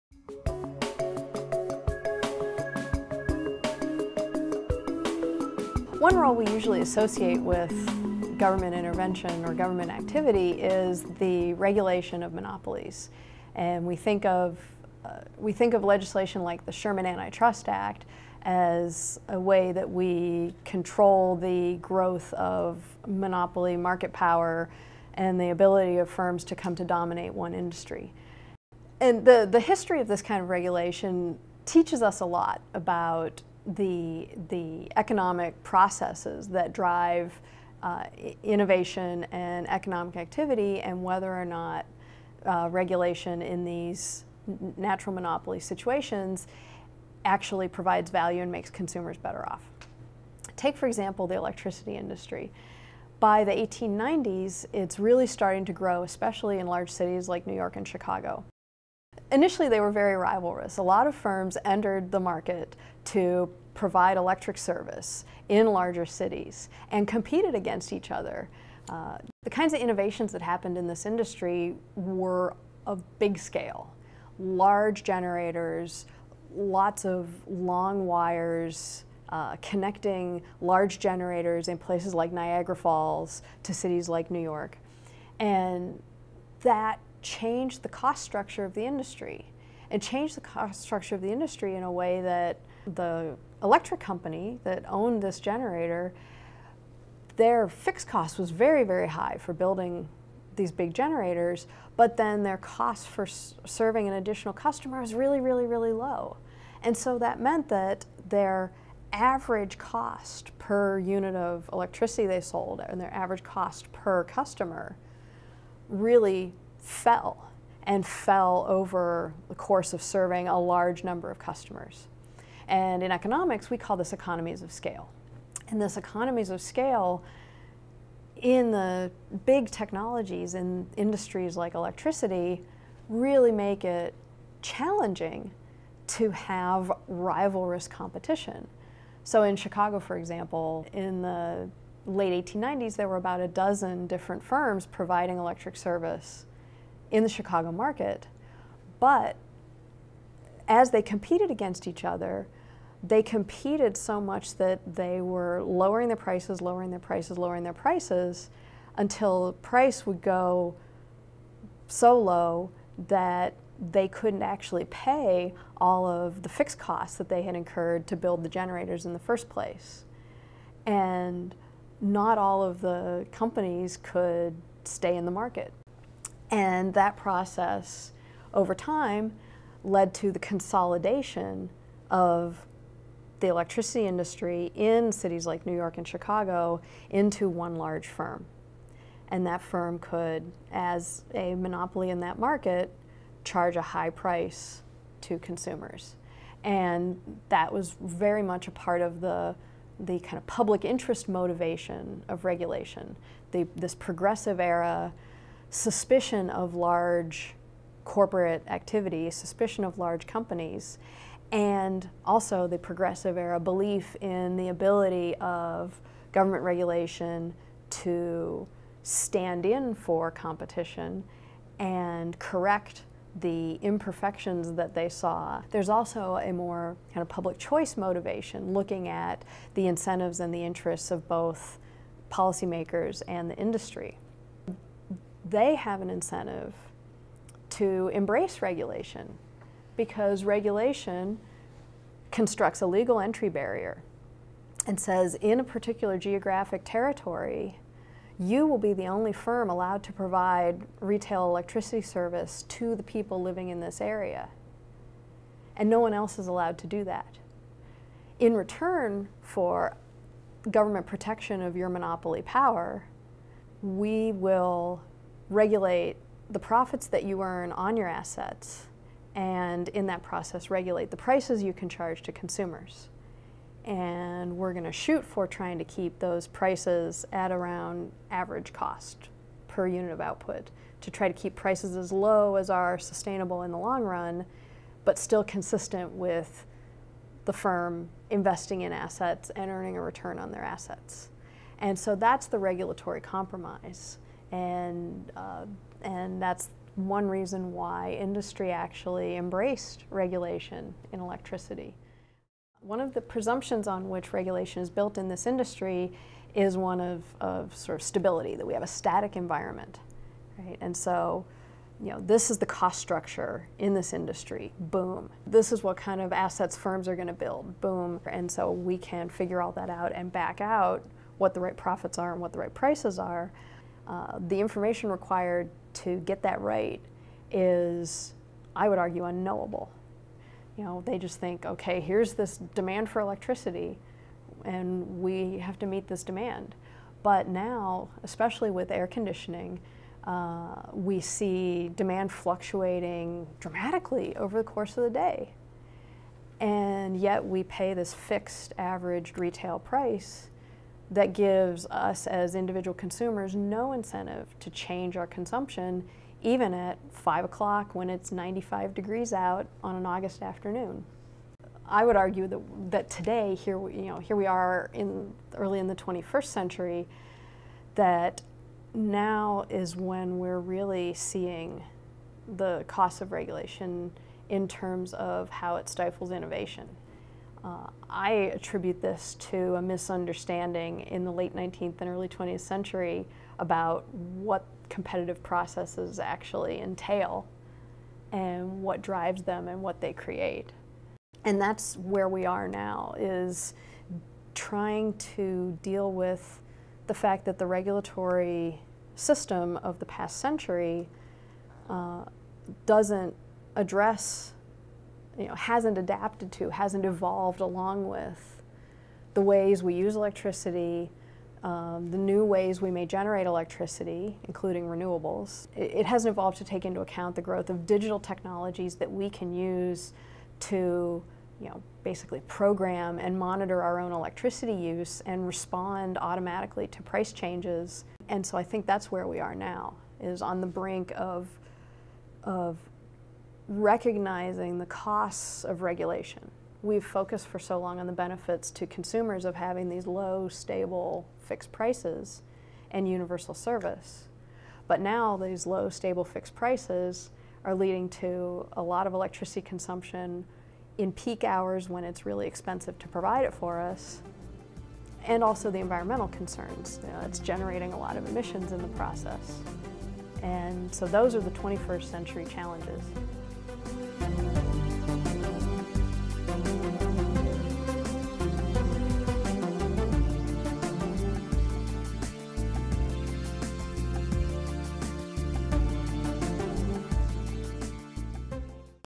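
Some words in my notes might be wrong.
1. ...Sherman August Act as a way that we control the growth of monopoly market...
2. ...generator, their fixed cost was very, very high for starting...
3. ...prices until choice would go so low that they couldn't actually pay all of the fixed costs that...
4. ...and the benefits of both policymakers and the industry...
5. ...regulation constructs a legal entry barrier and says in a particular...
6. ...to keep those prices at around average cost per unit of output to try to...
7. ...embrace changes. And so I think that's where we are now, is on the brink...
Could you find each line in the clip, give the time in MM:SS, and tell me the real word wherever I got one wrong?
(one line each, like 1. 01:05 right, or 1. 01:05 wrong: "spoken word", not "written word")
1. 00:16 wrong: "Antitrust", not "August"
2. 01:35 wrong: "building", not "starting"
3. 02:37 wrong: "price", not "choice"
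4. 03:50 wrong: "interests", not "benefits"
5. 04:00 right
6. 04:35 right
7. 07:07 wrong: "price", not "embrace".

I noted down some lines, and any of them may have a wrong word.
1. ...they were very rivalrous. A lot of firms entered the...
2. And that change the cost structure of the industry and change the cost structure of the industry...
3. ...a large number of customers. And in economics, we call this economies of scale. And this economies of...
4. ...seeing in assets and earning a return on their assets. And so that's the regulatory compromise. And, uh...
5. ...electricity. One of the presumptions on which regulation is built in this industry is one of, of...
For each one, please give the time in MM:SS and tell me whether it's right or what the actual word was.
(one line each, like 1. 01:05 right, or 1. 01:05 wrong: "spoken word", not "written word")
1. 00:59 right
2. 01:25 right
3. 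02:00 right
4. 04:48 wrong: "investing", not "seeing"
5. 05:01 right.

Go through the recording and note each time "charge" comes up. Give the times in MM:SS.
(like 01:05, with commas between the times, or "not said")
03:13, 04:31.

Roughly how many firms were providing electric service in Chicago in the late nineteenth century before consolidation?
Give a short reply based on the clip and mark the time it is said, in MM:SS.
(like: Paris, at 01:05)
about a dozen, at 02:23.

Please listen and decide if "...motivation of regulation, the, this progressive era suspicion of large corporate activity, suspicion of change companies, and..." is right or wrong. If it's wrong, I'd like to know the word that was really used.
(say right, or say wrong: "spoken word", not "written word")
wrong: "large", not "change".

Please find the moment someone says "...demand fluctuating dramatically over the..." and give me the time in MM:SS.
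05:41.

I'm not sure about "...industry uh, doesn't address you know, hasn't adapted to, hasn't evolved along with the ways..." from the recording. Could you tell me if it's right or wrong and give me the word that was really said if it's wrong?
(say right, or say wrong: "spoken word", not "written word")
wrong: "century", not "industry".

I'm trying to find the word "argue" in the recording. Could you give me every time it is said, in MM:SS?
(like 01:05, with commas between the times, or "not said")
05:28, 06:02.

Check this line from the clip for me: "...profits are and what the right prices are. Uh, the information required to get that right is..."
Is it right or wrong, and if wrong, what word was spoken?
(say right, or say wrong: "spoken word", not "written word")
right.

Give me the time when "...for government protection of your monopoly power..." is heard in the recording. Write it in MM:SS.
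04:19.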